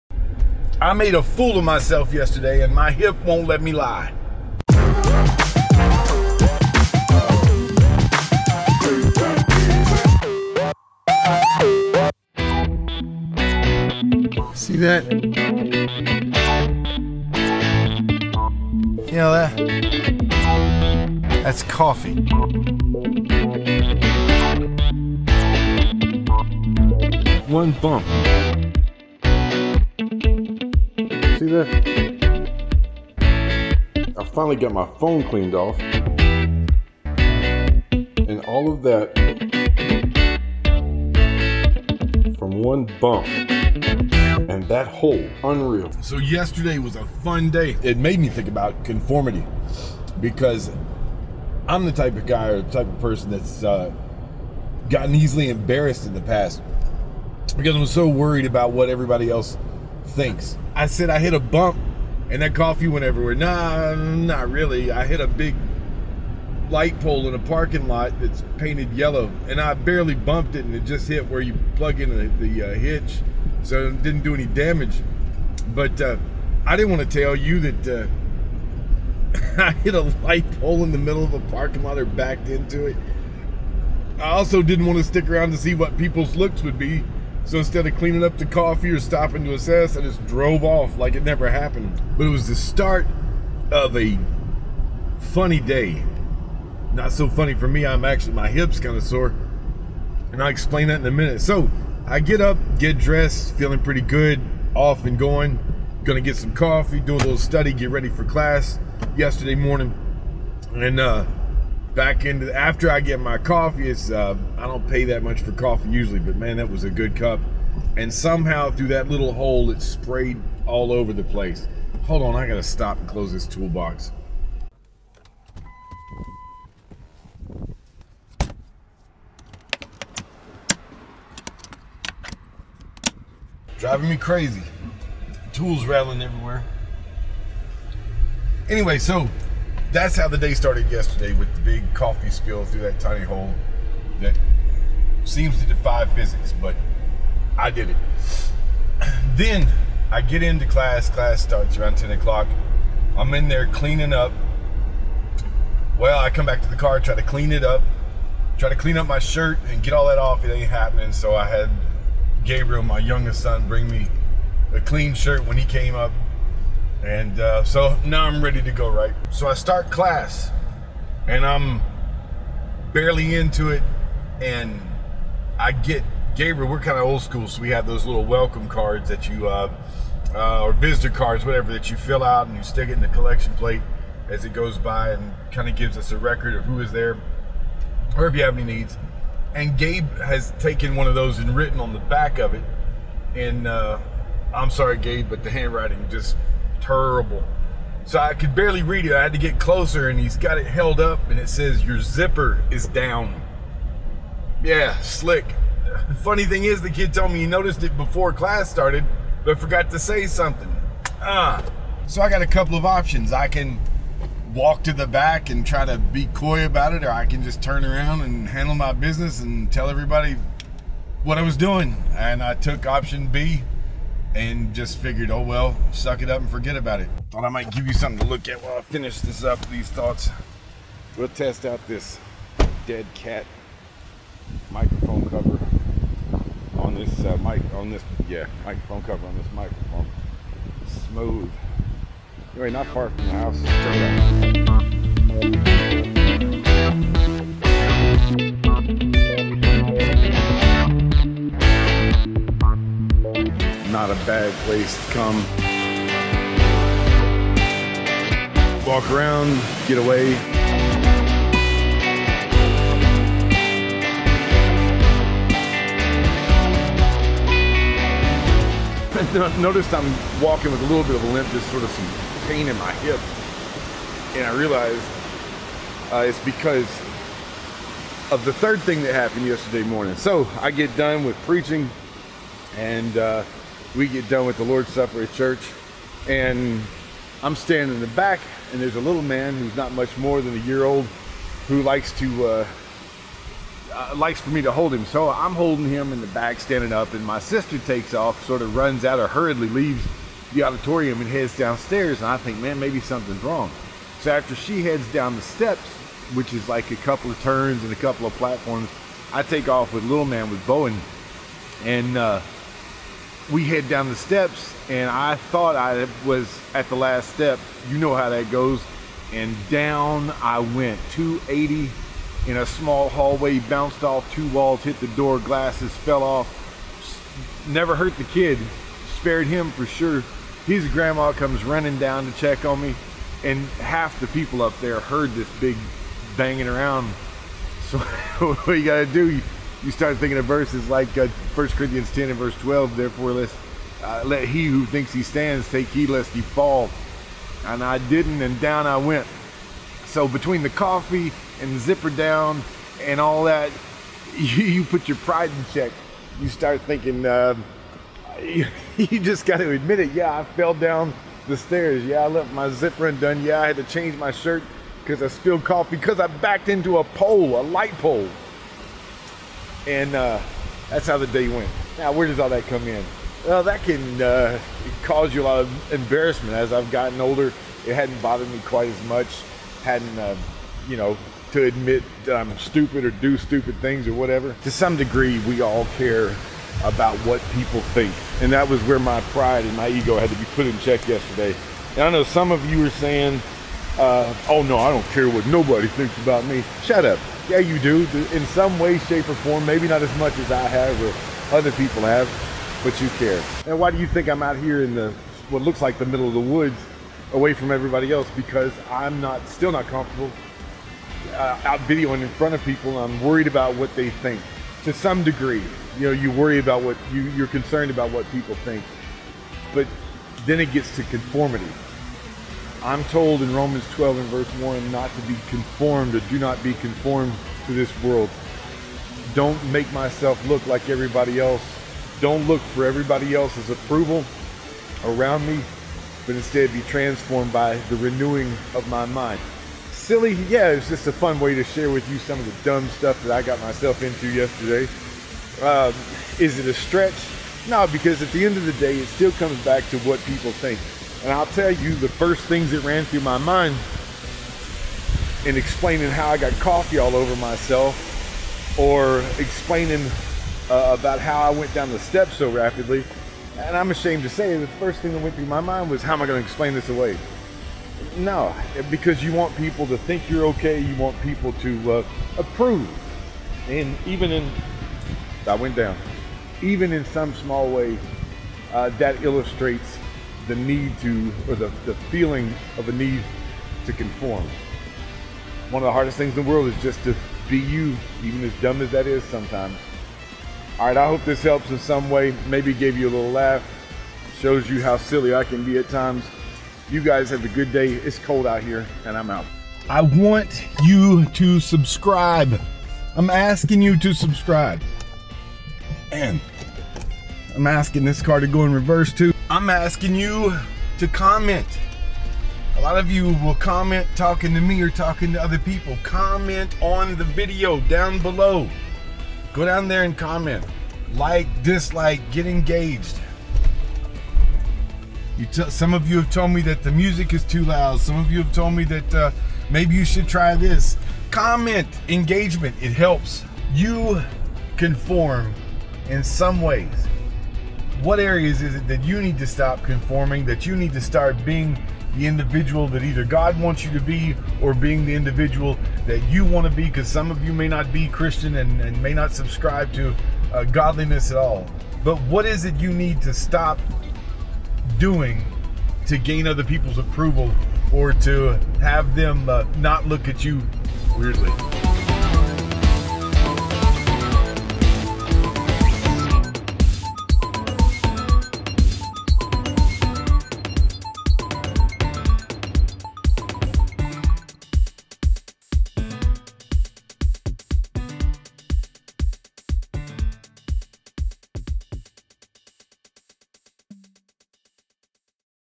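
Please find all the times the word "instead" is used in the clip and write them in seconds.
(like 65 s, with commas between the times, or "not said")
87 s, 436 s.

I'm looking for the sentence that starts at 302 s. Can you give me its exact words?
And I think, man, maybe something's wrong.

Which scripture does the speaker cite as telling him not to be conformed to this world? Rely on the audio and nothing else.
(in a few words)
Romans 12:1.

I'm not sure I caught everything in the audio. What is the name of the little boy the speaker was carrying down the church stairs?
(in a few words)
Bowen.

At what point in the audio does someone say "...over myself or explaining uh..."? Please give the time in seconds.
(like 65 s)
457 s.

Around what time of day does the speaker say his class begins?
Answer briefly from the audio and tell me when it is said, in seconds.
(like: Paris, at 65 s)
10 o'clock, at 151 s.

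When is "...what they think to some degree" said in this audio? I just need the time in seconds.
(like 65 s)
413 s.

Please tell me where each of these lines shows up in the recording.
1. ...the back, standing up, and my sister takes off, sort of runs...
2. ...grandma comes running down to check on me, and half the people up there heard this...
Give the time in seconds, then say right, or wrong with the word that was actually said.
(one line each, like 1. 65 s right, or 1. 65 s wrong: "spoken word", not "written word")
1. 296 s right
2. 330 s right.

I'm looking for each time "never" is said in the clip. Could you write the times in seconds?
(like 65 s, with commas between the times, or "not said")
91 s, 327 s.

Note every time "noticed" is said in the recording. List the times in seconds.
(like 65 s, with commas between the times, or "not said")
207 s, 269 s.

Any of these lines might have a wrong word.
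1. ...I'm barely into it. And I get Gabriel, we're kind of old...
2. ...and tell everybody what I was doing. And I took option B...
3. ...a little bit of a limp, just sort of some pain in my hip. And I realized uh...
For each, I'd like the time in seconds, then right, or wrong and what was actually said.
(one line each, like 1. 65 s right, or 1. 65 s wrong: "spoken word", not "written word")
1. 171 s right
2. 219 s right
3. 270 s right.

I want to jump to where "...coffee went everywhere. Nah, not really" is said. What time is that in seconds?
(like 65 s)
62 s.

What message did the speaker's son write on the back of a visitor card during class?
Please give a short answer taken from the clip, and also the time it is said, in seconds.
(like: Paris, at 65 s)
Your zipper is down, at 201 s.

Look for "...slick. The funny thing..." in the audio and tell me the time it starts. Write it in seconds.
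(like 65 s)
205 s.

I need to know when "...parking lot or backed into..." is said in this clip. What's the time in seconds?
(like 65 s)
81 s.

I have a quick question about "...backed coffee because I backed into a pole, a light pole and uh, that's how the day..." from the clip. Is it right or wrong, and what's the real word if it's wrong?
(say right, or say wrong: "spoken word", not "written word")
wrong: "spilled", not "backed".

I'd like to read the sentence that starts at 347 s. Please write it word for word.
And I didn't, and down I went.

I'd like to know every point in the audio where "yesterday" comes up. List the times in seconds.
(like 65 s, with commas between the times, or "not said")
2 s, 46 s, 109 s, 140 s, 279 s, 391 s, 444 s.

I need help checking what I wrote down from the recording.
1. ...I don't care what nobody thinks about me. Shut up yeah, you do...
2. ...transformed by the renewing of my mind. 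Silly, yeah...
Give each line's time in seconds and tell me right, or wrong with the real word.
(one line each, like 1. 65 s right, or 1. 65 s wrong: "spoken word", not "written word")
1. 394 s right
2. 436 s right.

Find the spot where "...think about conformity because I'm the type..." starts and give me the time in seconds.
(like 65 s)
48 s.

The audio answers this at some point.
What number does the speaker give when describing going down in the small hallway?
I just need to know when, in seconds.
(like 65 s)
321 s.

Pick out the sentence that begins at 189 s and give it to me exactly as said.
And Gabe has taken one of those and written on the back of it.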